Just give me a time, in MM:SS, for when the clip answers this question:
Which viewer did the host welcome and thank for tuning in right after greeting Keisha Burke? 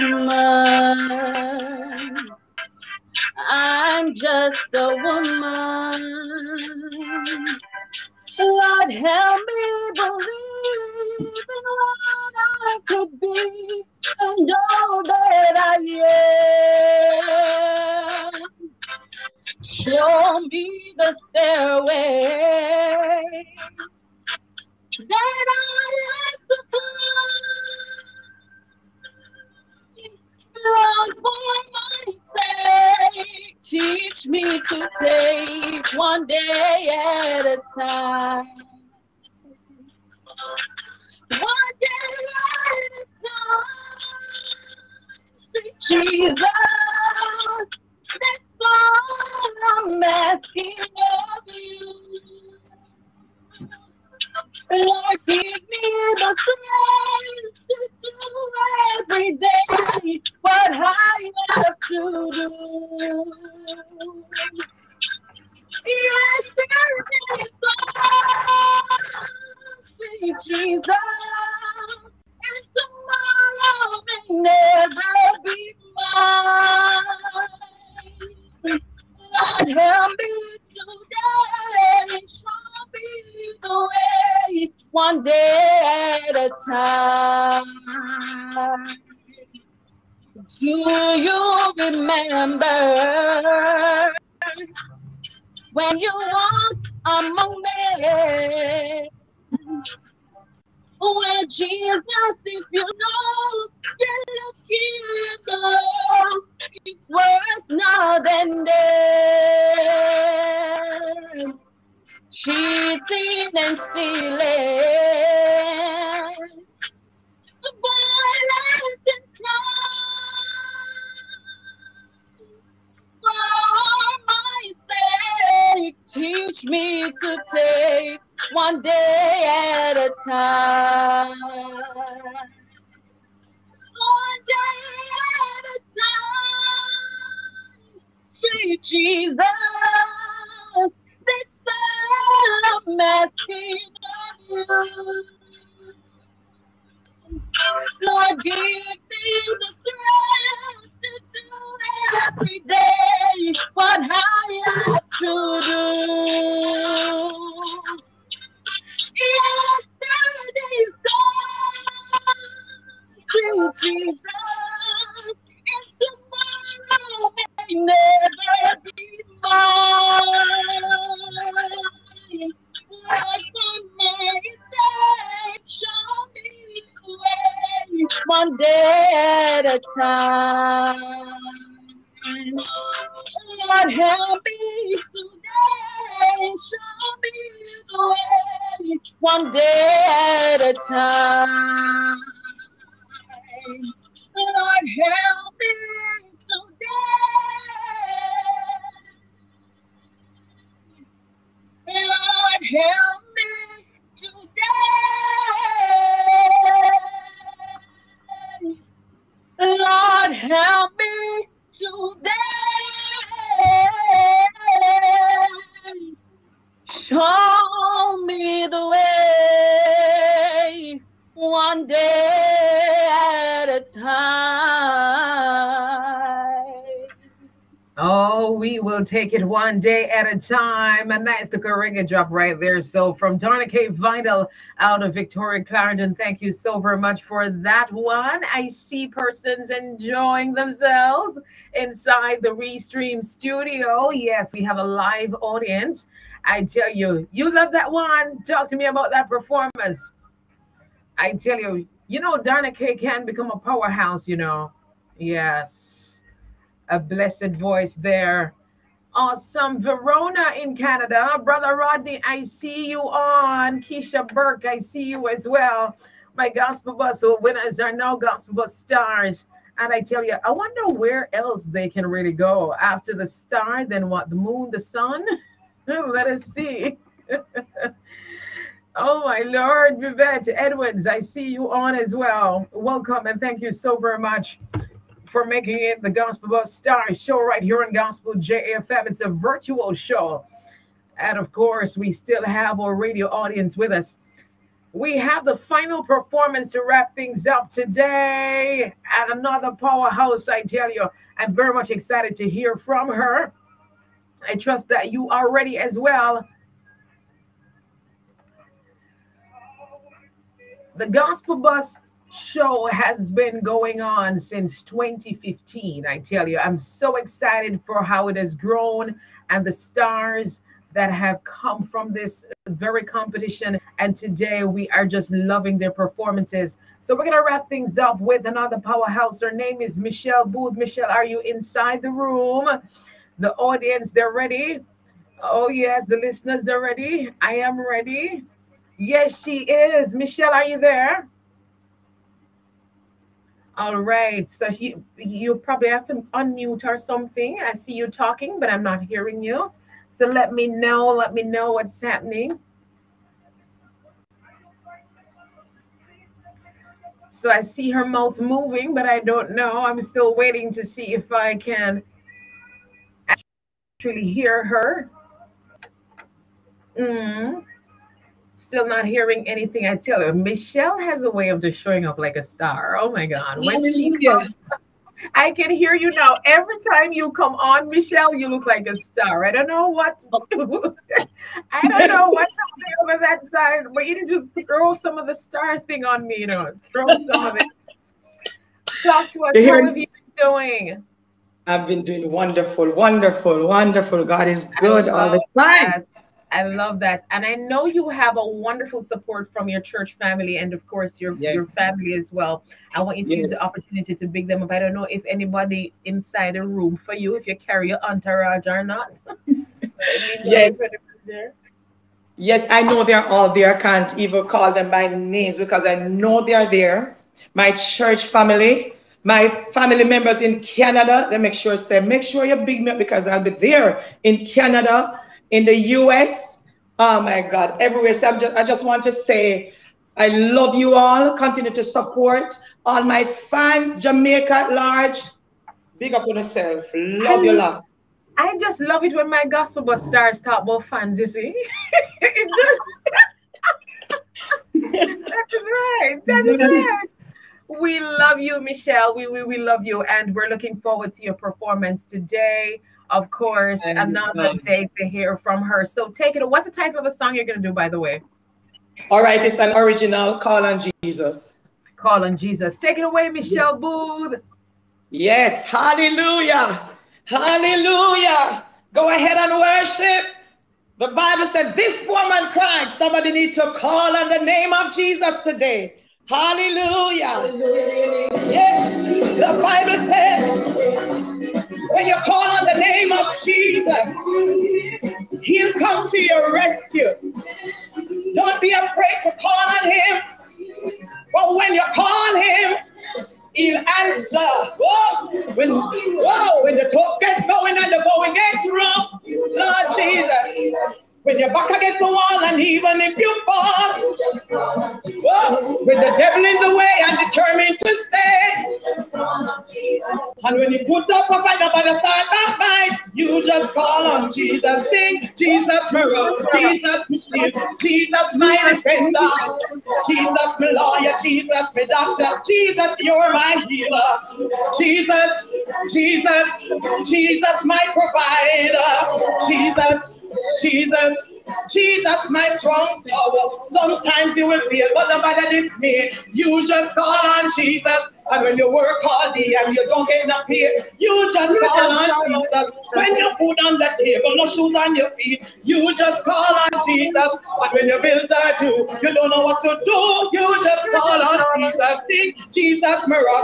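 04:39.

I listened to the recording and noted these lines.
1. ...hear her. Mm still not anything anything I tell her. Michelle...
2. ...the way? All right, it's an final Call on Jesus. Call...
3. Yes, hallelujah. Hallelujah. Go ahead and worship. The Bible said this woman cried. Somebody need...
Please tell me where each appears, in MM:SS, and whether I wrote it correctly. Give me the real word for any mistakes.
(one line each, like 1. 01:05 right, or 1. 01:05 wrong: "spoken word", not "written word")
1. 06:04 wrong: "hearing", not "anything"
2. 07:37 wrong: "original", not "final"
3. 07:45 right.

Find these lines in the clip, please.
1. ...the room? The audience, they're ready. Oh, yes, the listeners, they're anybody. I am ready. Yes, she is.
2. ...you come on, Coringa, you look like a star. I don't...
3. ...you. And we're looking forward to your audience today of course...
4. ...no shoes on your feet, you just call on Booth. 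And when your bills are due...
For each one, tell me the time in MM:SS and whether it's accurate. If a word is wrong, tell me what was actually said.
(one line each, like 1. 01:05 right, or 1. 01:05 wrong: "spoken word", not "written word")
1. 05:32 wrong: "ready", not "anybody"
2. 06:17 wrong: "Michelle", not "Coringa"
3. 07:29 wrong: "performance", not "audience"
4. 09:04 wrong: "Jesus", not "Booth".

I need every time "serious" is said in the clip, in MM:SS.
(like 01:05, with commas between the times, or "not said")
not said.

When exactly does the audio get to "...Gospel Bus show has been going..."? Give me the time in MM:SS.
05:11.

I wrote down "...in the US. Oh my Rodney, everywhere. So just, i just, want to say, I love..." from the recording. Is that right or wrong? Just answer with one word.
wrong.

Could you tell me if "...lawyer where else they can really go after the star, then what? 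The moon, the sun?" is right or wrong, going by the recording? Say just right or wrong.
wrong.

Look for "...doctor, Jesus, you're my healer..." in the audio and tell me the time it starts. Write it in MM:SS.
08:41.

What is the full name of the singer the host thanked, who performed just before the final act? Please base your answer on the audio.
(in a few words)
Victoria Clarendon.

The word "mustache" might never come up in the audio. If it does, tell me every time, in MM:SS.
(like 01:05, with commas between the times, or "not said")
not said.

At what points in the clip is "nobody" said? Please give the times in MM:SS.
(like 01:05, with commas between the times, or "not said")
08:31.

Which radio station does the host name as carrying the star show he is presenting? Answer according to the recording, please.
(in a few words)
Gospel JFM.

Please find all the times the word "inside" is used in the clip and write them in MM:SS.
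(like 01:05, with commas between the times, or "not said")
04:01, 05:31, 06:46.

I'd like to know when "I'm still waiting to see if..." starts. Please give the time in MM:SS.
05:59.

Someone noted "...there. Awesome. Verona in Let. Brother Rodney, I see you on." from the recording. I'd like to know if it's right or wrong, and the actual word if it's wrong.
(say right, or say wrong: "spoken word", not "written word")
wrong: "Canada", not "Let".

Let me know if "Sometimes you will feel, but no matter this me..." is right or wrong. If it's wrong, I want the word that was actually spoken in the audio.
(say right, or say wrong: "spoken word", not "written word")
right.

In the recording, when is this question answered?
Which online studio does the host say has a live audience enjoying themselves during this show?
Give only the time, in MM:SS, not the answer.
04:02.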